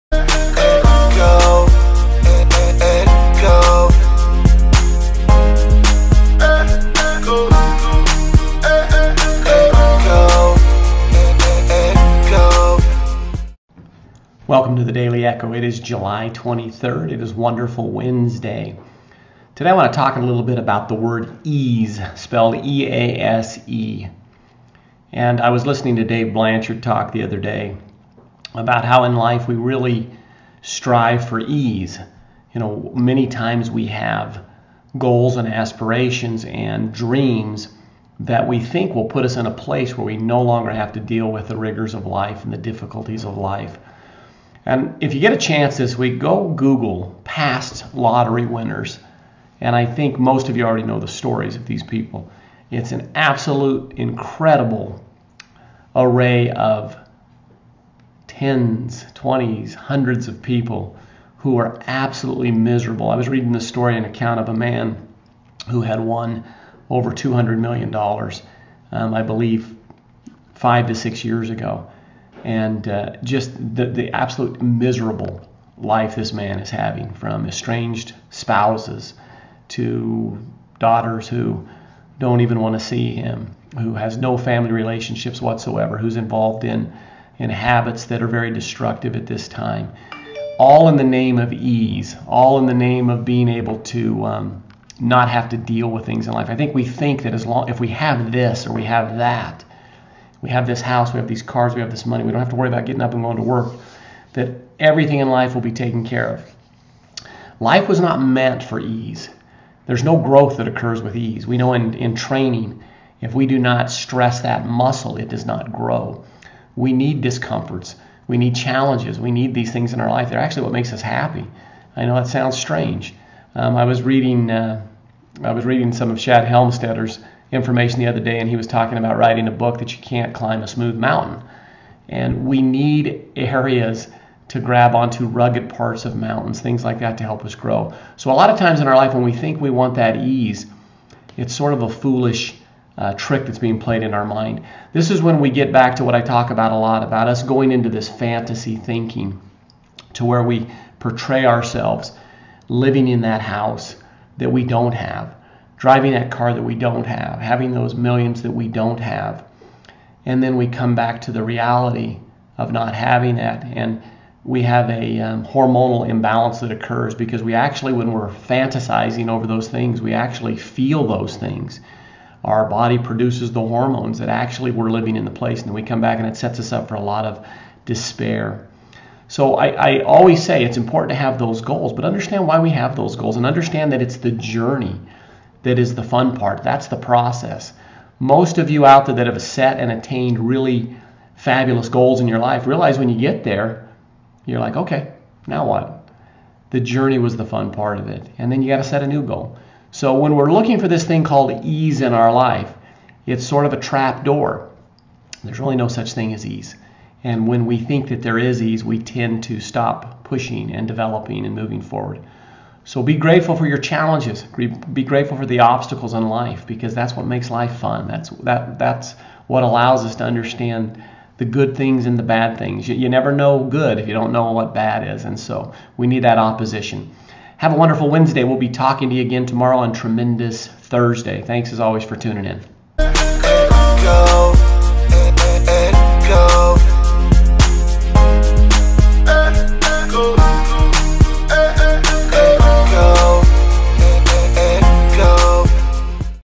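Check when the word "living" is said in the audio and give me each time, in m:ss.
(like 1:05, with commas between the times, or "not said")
2:32, 2:54.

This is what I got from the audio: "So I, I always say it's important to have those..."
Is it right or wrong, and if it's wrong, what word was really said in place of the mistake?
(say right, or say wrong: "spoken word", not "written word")
right.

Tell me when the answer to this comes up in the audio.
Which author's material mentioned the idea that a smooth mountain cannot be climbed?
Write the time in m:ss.
2:06.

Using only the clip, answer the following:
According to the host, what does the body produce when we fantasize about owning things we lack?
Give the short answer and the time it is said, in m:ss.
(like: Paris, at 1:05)
Hormones, at 2:53.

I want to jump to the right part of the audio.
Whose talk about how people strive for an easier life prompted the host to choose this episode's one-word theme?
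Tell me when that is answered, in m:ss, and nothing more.
0:26.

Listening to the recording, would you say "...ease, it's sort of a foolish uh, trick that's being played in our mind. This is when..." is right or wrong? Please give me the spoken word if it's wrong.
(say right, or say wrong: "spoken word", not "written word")
right.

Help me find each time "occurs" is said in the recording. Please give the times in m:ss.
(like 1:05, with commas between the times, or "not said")
1:50, 2:46.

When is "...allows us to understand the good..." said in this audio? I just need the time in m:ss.
3:39.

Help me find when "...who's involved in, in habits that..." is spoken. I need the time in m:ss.
1:25.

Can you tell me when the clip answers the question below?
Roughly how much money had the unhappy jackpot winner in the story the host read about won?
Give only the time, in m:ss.
1:06.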